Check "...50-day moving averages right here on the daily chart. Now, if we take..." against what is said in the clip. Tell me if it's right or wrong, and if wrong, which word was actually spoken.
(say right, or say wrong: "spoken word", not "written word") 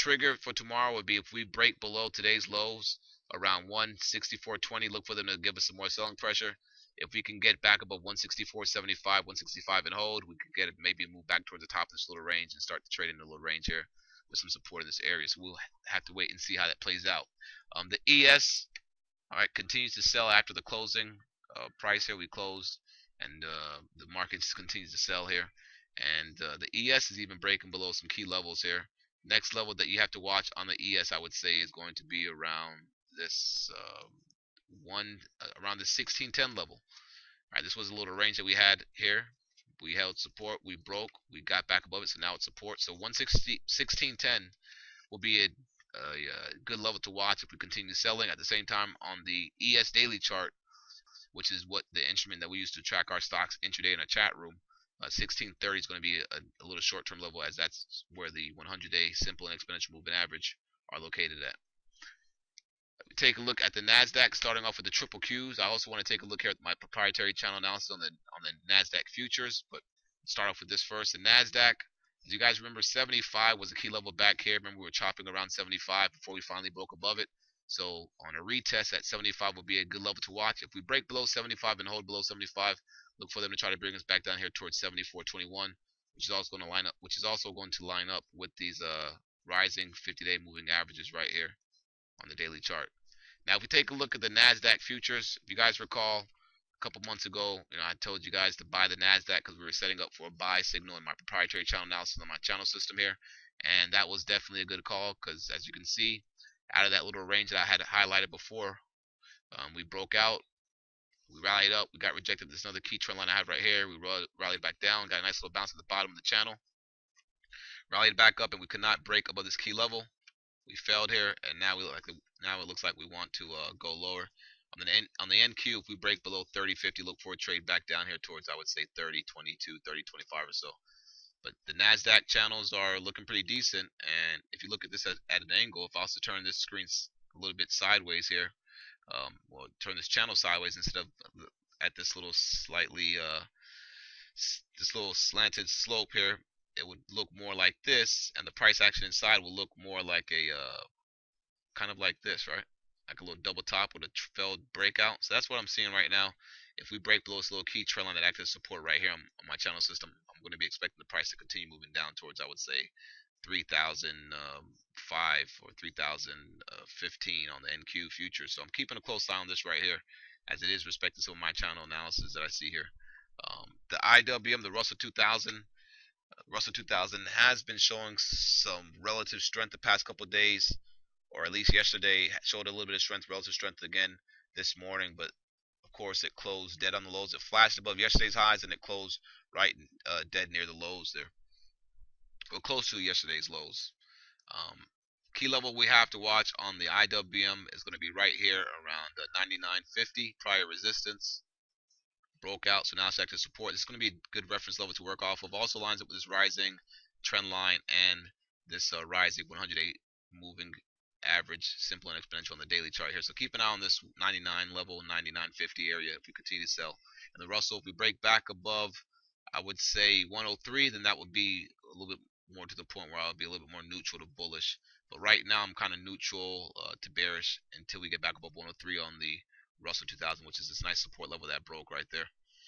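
right.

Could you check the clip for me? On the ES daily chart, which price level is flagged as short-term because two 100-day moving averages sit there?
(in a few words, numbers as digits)
1630.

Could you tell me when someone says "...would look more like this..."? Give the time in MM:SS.
02:26.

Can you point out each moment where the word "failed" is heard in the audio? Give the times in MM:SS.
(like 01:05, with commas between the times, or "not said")
02:00, 02:34.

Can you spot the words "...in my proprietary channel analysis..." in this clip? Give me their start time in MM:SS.
01:40.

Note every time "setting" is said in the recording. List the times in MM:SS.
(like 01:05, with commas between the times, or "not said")
01:39.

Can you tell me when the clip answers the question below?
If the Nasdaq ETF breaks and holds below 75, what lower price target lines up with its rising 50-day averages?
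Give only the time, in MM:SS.
01:24.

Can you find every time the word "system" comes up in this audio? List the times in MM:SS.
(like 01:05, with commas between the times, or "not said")
01:42, 02:39.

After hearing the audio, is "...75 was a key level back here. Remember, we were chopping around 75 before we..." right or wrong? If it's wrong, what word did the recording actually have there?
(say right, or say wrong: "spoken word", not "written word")
right.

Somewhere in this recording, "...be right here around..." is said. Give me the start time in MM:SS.
03:17.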